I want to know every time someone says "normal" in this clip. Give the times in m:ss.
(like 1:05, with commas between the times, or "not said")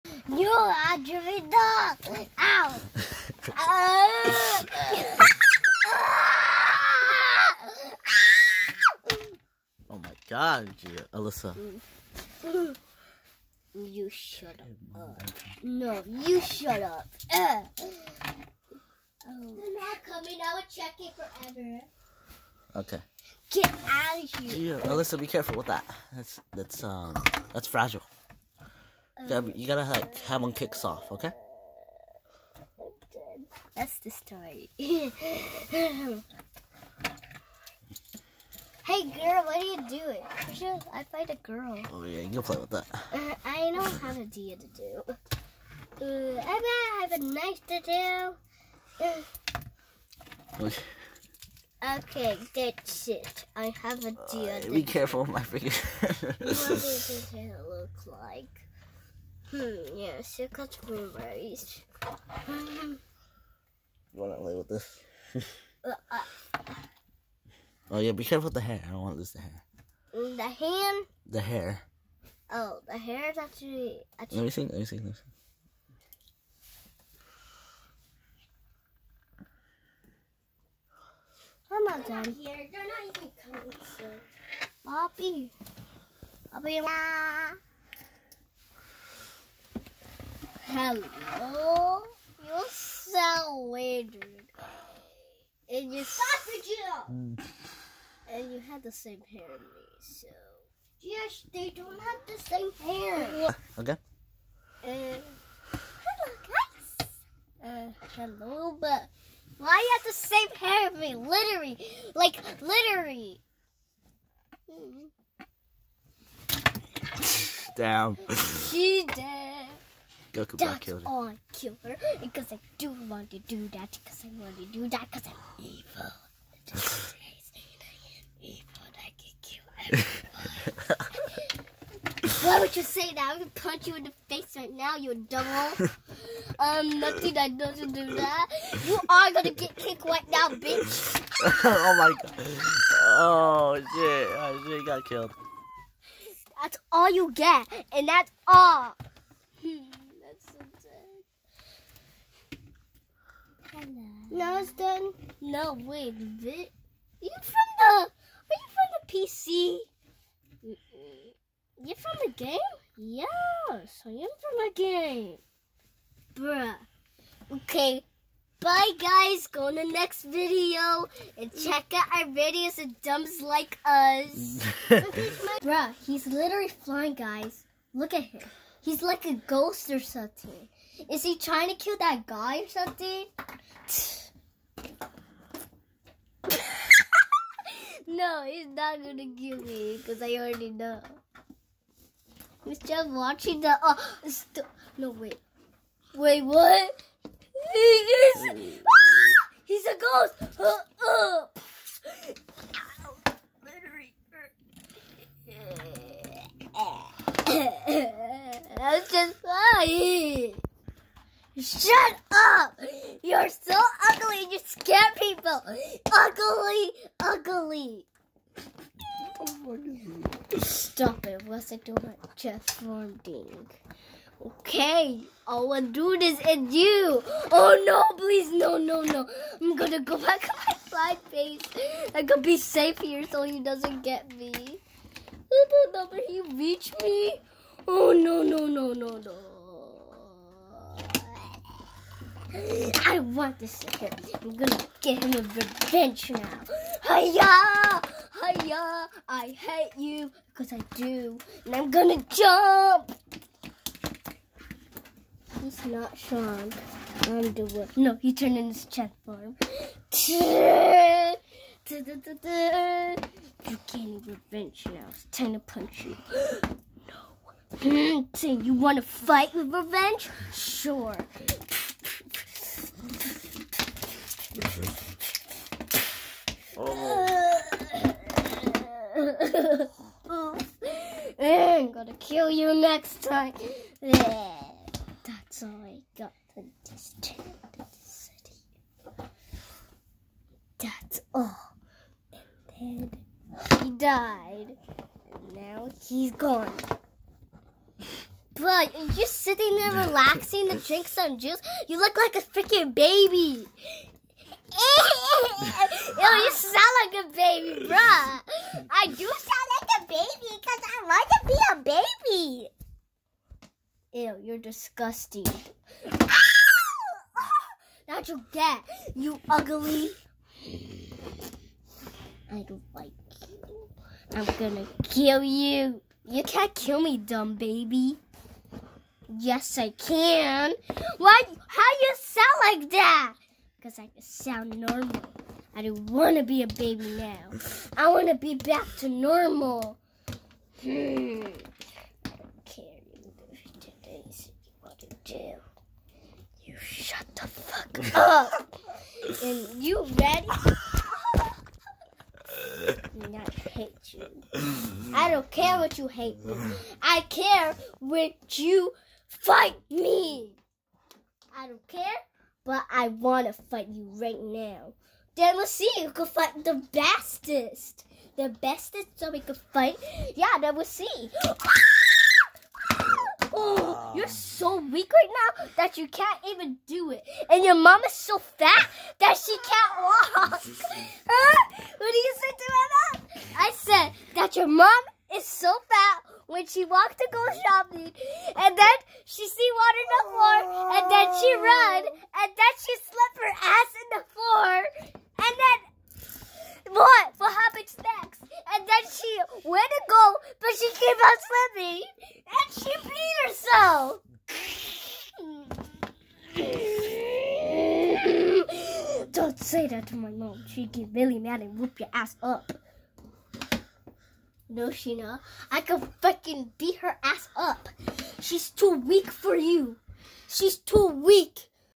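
5:34, 5:39.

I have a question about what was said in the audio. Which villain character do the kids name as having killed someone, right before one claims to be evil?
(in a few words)
Goku Black.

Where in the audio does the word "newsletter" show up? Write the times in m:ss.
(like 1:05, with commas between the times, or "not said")
not said.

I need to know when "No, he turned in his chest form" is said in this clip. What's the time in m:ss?
4:17.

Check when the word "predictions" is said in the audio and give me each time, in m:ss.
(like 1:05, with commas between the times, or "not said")
not said.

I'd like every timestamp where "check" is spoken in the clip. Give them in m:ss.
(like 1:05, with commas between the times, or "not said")
0:20, 2:51.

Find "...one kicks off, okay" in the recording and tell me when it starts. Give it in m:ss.
0:30.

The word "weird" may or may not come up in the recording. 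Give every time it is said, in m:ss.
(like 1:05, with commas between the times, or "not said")
1:33.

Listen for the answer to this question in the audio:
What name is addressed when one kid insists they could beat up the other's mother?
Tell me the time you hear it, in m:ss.
6:54.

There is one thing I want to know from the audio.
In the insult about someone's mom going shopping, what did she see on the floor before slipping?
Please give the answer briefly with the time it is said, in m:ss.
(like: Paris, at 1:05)
Water, at 6:29.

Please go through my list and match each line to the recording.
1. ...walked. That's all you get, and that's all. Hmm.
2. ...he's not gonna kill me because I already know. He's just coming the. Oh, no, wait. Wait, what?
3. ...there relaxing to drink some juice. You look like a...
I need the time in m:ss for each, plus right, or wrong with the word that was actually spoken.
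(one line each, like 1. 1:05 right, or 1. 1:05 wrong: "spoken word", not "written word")
1. 2:25 wrong: "killed", not "walked"
2. 3:08 wrong: "watching", not "coming"
3. 4:59 right.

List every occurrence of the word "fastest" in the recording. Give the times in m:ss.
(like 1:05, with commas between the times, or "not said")
6:06.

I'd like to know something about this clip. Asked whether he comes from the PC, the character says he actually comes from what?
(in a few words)
A game.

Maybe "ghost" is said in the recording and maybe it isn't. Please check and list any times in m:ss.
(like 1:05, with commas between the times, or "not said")
2:59, 3:19.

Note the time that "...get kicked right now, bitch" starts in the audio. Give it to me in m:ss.
2:19.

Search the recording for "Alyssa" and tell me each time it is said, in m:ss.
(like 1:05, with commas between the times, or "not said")
0:11, 0:24.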